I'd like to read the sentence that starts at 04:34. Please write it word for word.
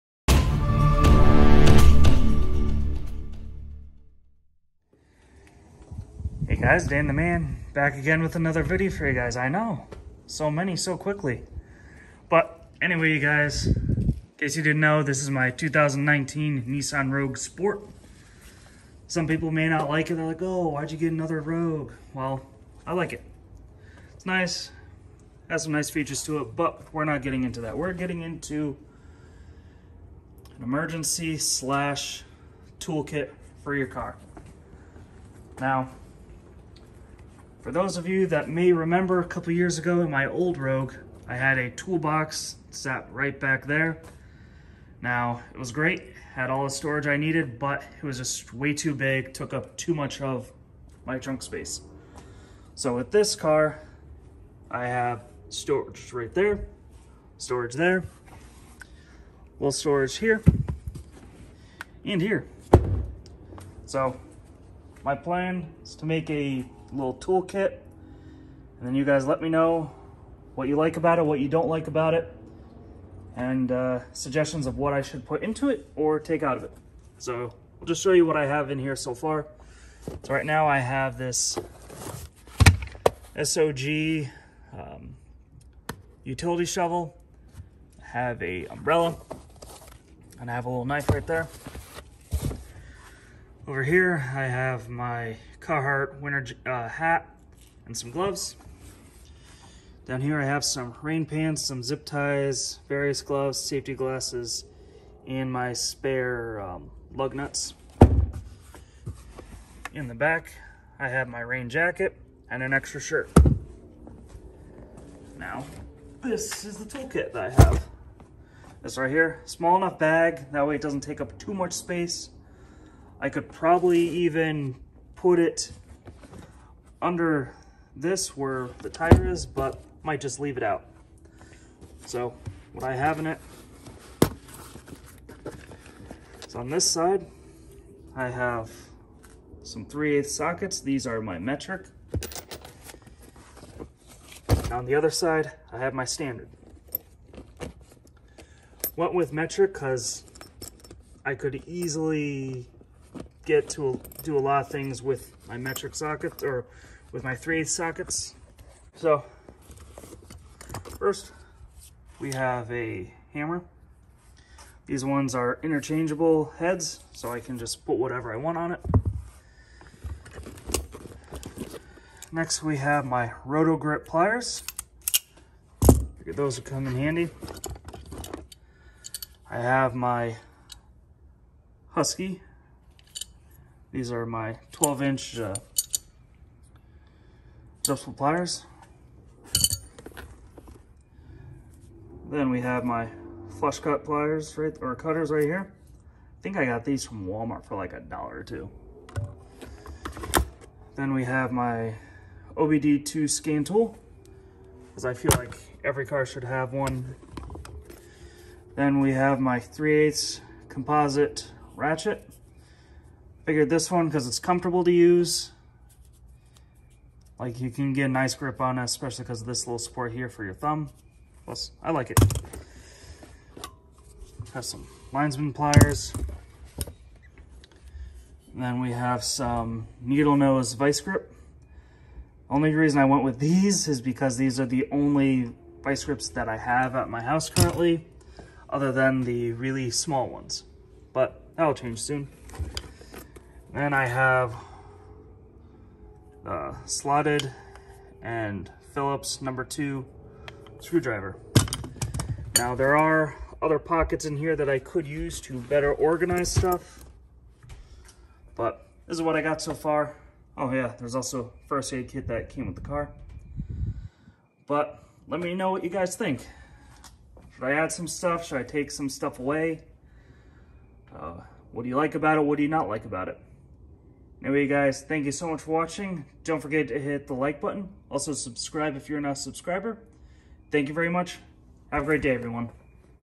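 Anyway, guys, thank you so much for watching.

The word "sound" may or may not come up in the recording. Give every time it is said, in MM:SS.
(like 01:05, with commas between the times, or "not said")
not said.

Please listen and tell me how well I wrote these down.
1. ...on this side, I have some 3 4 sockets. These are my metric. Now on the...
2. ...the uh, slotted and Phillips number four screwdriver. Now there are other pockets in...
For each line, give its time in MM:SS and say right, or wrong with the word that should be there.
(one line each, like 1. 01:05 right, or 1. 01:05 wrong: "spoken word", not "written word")
1. 02:16 wrong: "8", not "4"
2. 04:06 wrong: "two", not "four".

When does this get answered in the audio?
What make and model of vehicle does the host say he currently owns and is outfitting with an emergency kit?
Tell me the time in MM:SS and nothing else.
00:15.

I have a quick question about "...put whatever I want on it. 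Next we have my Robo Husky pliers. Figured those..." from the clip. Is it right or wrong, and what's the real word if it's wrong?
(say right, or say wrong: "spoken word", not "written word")
wrong: "Grip", not "Husky".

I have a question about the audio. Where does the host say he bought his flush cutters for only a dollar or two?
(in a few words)
Walmart.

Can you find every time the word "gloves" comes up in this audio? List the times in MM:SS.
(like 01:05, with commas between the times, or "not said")
01:38, 01:43.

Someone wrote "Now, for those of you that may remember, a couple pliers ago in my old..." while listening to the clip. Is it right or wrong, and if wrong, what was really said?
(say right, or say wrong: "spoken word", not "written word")
wrong: "years", not "pliers".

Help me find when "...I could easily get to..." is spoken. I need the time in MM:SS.
02:31.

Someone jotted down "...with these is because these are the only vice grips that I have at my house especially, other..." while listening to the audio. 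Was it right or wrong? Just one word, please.
wrong.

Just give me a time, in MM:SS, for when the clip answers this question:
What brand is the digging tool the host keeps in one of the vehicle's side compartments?
01:23.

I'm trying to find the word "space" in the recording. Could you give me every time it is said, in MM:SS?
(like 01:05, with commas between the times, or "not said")
00:51, 02:01.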